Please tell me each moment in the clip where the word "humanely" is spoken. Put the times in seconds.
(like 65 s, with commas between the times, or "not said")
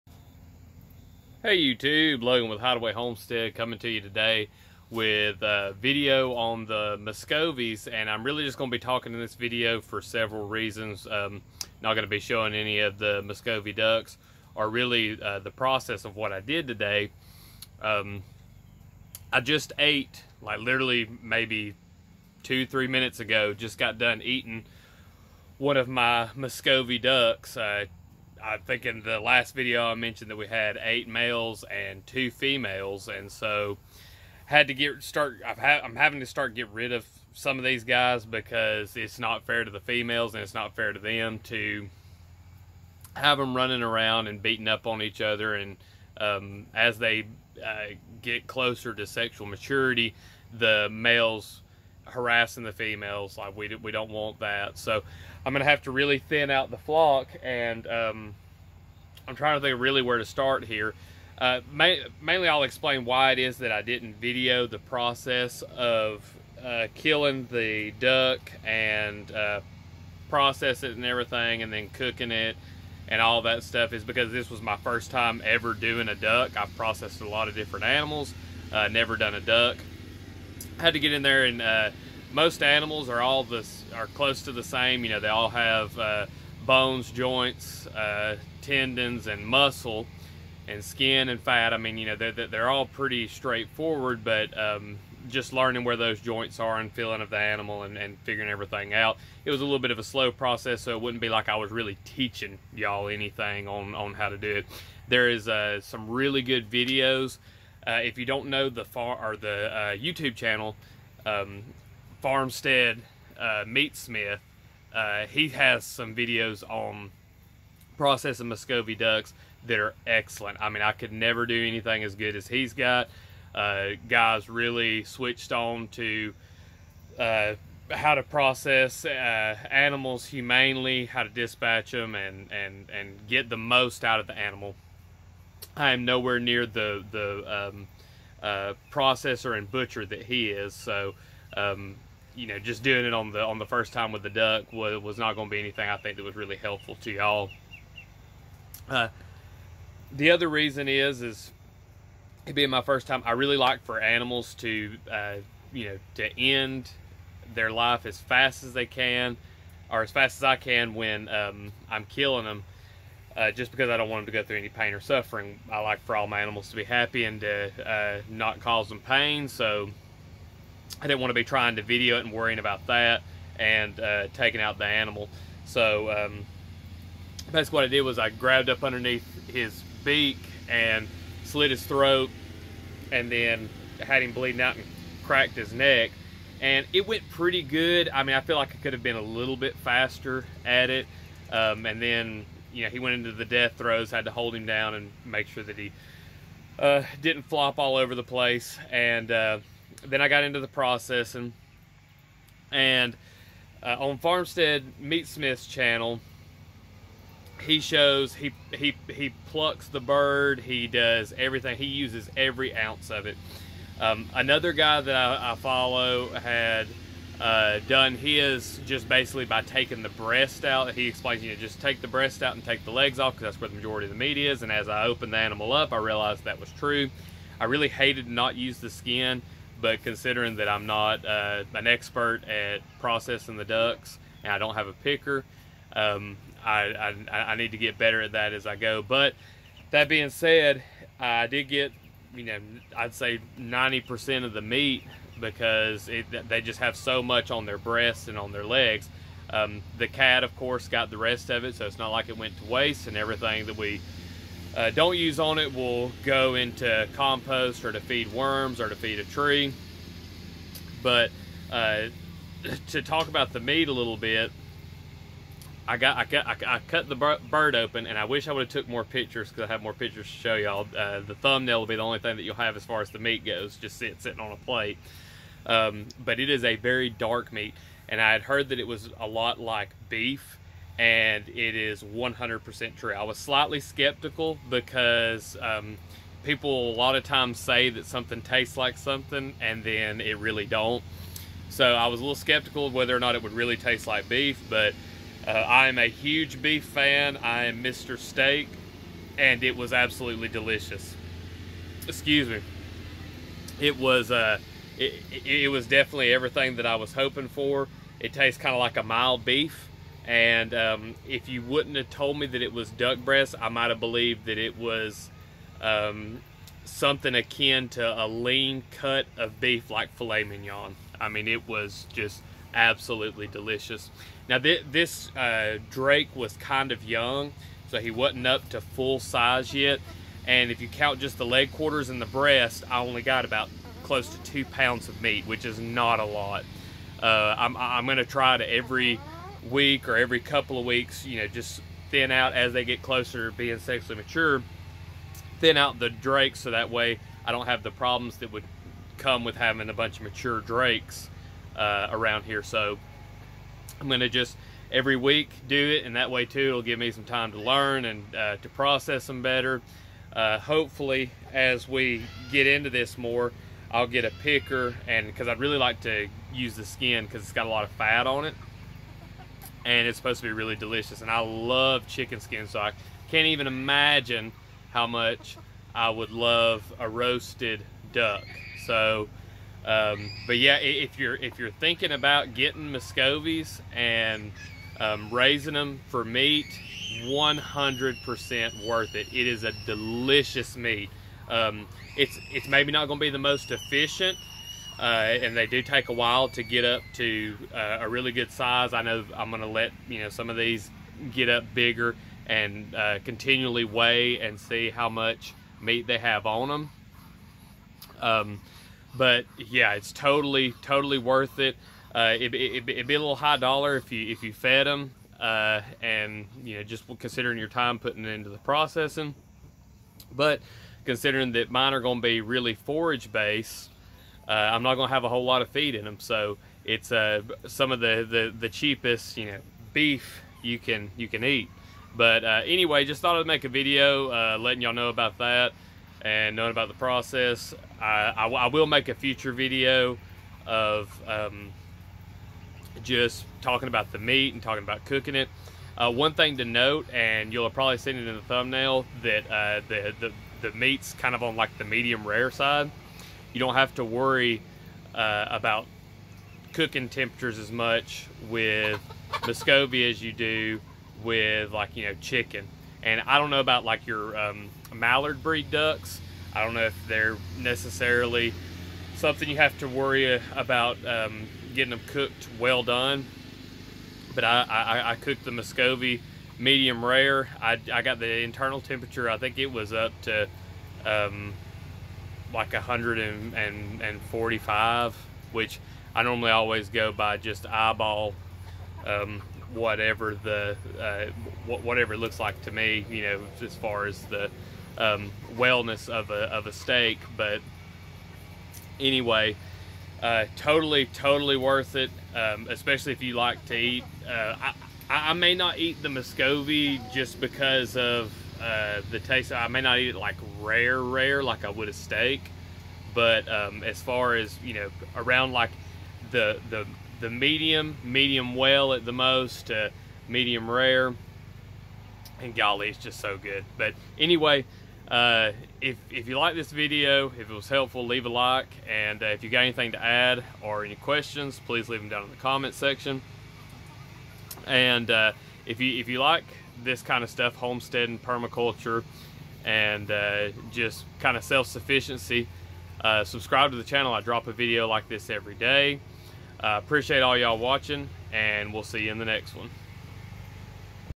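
130 s.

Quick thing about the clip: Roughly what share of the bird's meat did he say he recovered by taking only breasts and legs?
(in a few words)
90%.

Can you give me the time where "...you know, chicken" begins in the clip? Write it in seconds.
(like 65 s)
461 s.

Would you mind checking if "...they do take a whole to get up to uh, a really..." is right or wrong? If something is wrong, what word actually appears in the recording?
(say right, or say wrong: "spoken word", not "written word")
wrong: "while", not "whole".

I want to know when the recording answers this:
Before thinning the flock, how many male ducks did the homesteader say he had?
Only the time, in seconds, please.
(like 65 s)
30 s.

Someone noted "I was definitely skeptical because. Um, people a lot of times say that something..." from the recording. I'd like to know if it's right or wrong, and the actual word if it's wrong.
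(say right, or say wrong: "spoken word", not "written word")
wrong: "slightly", not "definitely".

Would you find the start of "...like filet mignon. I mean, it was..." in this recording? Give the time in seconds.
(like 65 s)
319 s.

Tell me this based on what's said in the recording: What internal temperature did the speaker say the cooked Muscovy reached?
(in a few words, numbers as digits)
145.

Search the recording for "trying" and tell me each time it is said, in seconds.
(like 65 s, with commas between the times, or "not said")
59 s, 171 s.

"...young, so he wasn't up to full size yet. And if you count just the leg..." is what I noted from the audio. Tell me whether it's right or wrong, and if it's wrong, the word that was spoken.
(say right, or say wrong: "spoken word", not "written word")
right.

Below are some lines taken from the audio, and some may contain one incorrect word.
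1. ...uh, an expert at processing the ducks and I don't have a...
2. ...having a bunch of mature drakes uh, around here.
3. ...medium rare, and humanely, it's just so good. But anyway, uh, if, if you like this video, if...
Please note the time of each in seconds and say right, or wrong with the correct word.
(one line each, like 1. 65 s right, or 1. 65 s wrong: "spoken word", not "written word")
1. 231 s right
2. 349 s right
3. 520 s wrong: "golly", not "humanely".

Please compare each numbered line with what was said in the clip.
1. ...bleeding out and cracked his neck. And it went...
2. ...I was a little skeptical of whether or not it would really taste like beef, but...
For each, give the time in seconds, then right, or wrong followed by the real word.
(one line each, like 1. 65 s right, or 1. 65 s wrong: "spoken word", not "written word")
1. 184 s right
2. 291 s right.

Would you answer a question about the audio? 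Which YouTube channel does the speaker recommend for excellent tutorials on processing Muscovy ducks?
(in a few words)
Farmstead Meatsmith.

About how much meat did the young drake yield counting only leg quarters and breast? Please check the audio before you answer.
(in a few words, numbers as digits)
2 pounds.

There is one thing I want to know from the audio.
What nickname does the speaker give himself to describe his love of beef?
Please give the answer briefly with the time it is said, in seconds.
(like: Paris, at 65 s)
Mr. Steak, at 297 s.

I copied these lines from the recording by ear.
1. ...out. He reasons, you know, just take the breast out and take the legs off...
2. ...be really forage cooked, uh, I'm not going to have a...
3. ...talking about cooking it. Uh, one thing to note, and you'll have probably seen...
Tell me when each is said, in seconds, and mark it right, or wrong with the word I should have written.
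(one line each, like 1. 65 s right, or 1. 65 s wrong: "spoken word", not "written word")
1. 220 s wrong: "explains", not "reasons"
2. 422 s wrong: "based", not "cooked"
3. 444 s right.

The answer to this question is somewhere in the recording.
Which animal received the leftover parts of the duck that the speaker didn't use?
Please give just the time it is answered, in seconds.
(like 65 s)
249 s.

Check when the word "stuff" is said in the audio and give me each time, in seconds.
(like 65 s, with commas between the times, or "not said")
73 s, 537 s.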